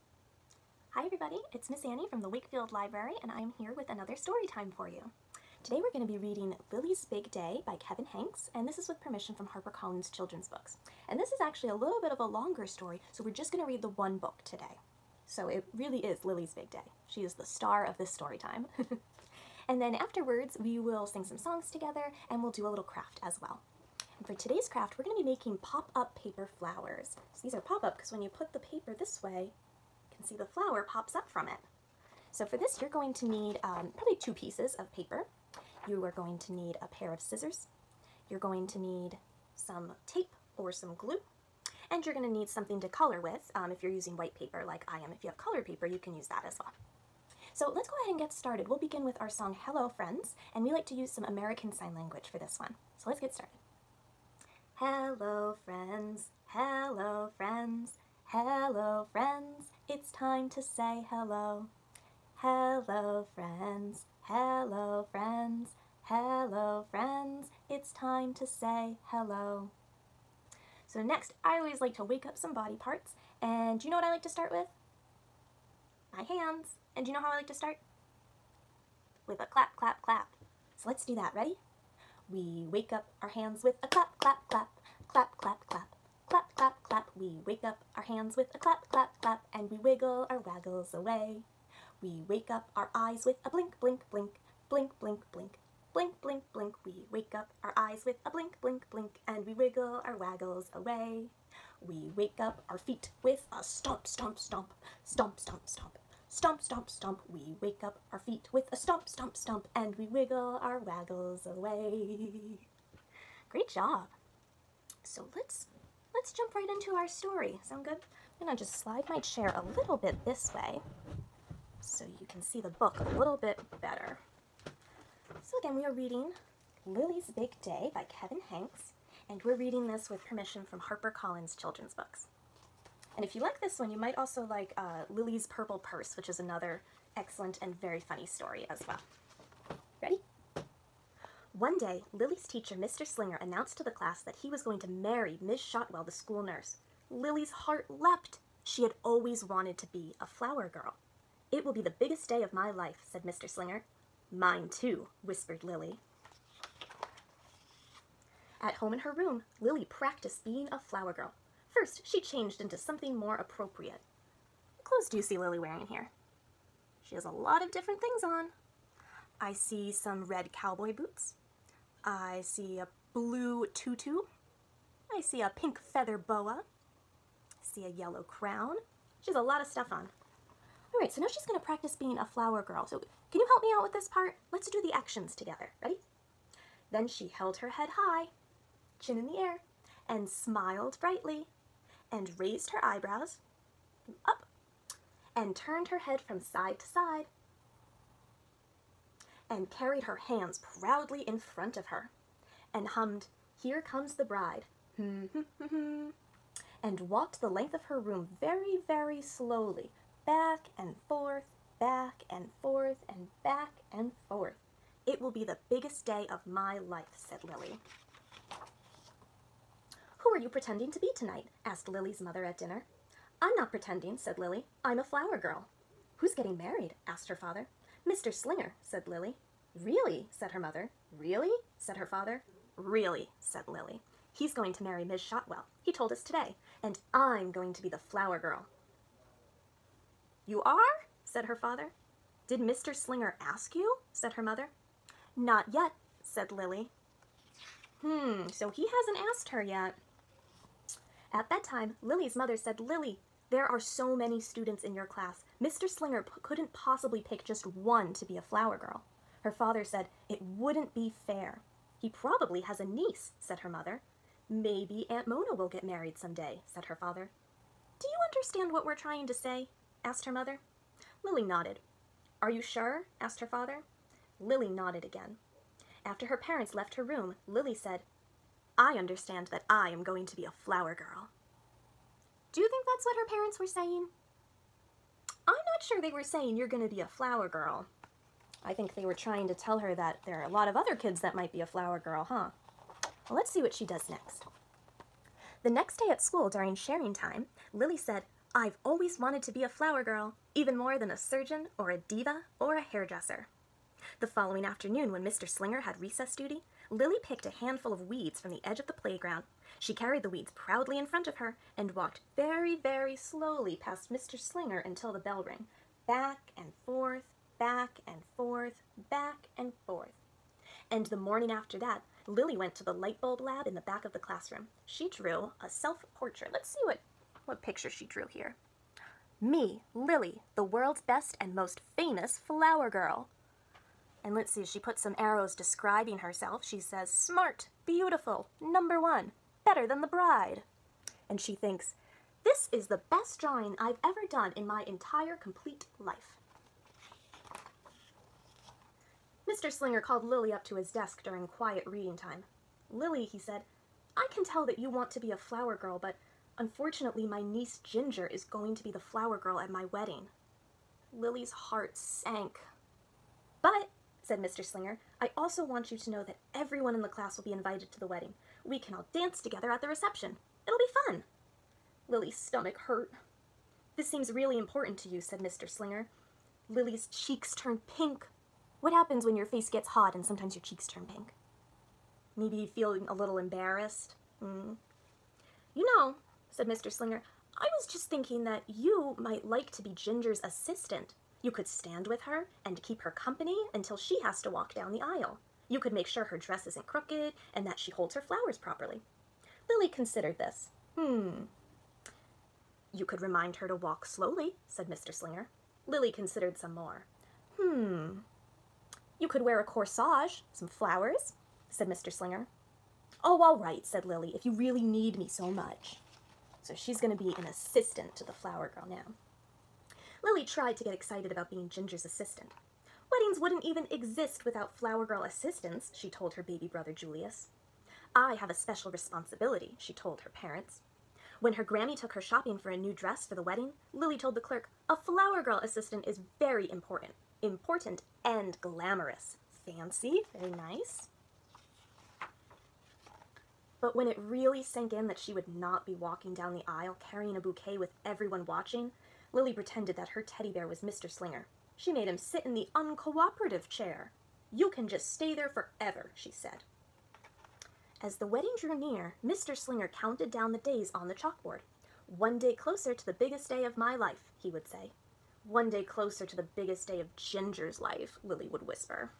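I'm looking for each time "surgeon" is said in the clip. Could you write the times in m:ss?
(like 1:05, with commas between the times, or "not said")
5:01.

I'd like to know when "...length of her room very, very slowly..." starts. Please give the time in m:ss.
3:27.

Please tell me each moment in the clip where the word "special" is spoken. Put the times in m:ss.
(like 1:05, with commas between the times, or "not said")
7:08.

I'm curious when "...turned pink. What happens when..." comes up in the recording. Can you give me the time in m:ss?
6:17.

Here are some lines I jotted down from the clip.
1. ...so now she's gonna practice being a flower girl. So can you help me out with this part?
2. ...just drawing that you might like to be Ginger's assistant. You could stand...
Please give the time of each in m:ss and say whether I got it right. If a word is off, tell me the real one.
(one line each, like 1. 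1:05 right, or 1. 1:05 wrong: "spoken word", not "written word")
1. 3:01 right
2. 6:27 wrong: "thinking", not "drawing".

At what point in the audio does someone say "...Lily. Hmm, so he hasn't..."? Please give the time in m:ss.
4:06.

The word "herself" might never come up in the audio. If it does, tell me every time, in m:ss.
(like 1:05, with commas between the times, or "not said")
5:36.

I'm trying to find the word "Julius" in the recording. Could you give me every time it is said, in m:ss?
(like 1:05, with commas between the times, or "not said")
7:06.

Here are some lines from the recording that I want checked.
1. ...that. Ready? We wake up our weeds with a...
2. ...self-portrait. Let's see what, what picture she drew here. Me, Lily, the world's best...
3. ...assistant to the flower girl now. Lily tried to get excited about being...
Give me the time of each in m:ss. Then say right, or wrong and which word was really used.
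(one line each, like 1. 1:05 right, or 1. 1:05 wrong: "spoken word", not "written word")
1. 1:21 wrong: "hands", not "weeds"
2. 5:25 right
3. 6:57 right.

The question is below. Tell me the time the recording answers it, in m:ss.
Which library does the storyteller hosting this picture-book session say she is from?
0:02.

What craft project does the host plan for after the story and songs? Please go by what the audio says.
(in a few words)
pop-up paper flowers.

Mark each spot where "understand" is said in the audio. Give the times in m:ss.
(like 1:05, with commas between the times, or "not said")
4:28, 4:38.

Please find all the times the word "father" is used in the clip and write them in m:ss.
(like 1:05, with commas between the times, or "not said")
3:47, 3:52, 4:01, 4:19, 4:26, 4:33.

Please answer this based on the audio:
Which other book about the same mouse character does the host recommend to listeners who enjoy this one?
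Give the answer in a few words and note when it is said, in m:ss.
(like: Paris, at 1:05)
Lily's Purple Purse, at 2:15.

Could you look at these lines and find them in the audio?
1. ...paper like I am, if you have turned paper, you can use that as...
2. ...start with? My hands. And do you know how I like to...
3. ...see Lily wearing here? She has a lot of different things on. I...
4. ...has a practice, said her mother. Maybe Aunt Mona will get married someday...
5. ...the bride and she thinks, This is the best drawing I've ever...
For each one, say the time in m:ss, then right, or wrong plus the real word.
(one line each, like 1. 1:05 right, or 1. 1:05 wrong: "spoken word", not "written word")
1. 0:44 wrong: "colored", not "turned"
2. 1:14 right
3. 2:45 right
4. 4:22 wrong: "niece", not "practice"
5. 5:40 right.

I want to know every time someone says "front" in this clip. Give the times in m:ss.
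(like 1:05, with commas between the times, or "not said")
3:21, 5:11.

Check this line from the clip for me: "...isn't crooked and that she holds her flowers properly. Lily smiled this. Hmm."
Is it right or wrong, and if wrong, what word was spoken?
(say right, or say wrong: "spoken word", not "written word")
wrong: "considered", not "smiled".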